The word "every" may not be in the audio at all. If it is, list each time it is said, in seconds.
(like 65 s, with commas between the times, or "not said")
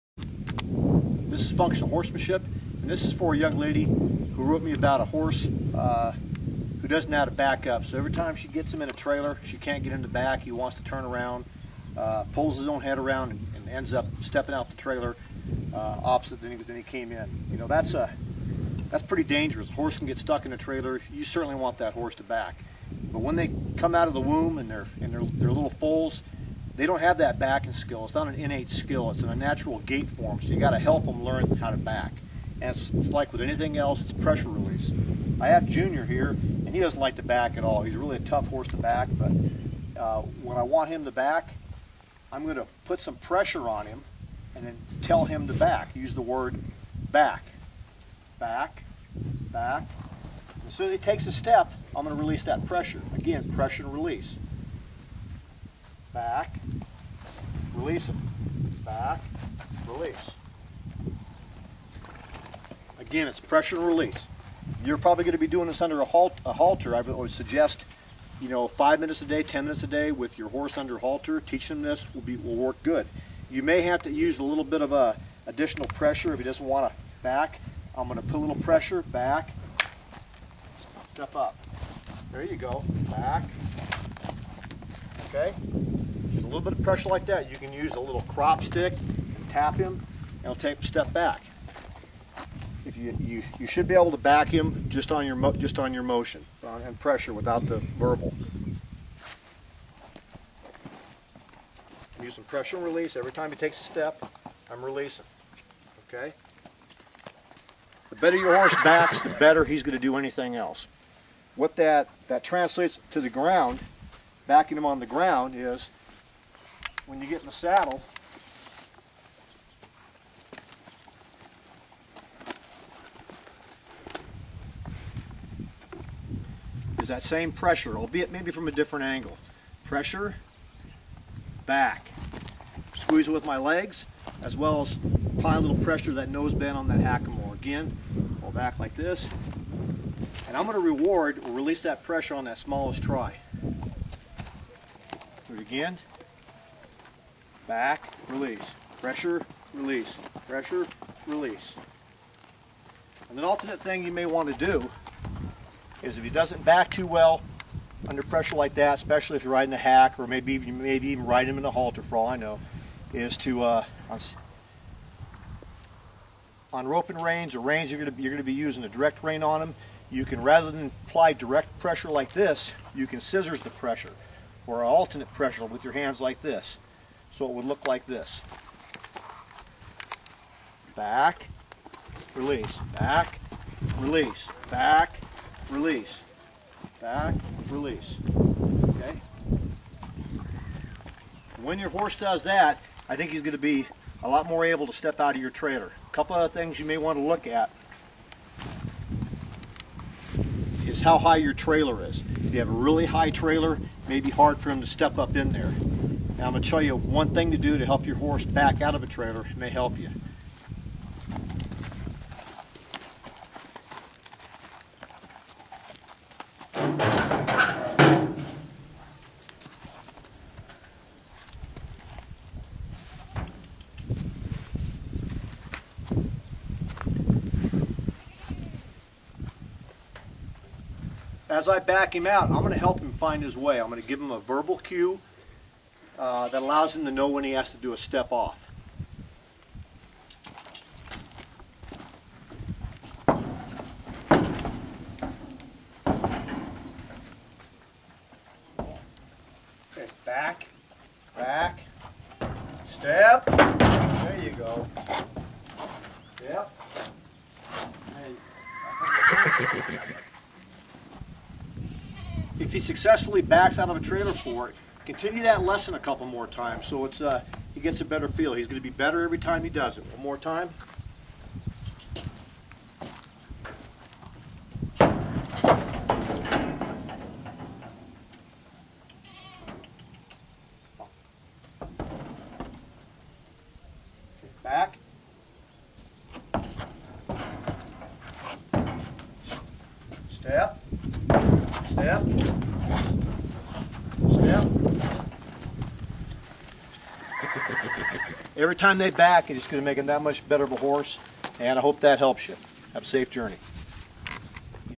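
7 s, 103 s, 269 s, 298 s.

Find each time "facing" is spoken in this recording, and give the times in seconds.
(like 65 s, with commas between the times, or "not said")
not said.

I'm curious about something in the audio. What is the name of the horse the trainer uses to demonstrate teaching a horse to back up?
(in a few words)
Junior.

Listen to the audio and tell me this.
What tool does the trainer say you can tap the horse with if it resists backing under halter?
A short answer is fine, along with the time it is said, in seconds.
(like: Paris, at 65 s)
crop stick, at 88 s.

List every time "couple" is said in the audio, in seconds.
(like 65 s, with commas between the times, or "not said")
196 s, 265 s.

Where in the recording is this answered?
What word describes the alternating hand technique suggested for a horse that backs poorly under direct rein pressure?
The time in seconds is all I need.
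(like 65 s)
173 s.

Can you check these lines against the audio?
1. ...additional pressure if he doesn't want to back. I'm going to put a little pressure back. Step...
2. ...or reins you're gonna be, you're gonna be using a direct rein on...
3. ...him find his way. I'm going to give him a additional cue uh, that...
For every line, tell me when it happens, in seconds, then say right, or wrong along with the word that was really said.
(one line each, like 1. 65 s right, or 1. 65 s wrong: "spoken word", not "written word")
1. 75 s right
2. 167 s right
3. 232 s wrong: "verbal", not "additional".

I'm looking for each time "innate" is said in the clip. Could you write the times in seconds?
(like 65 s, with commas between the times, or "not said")
28 s.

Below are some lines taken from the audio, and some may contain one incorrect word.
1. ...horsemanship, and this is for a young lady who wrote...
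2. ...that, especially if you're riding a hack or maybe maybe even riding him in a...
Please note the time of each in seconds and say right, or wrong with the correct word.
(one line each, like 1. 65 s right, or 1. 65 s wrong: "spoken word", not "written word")
1. 1 s right
2. 158 s right.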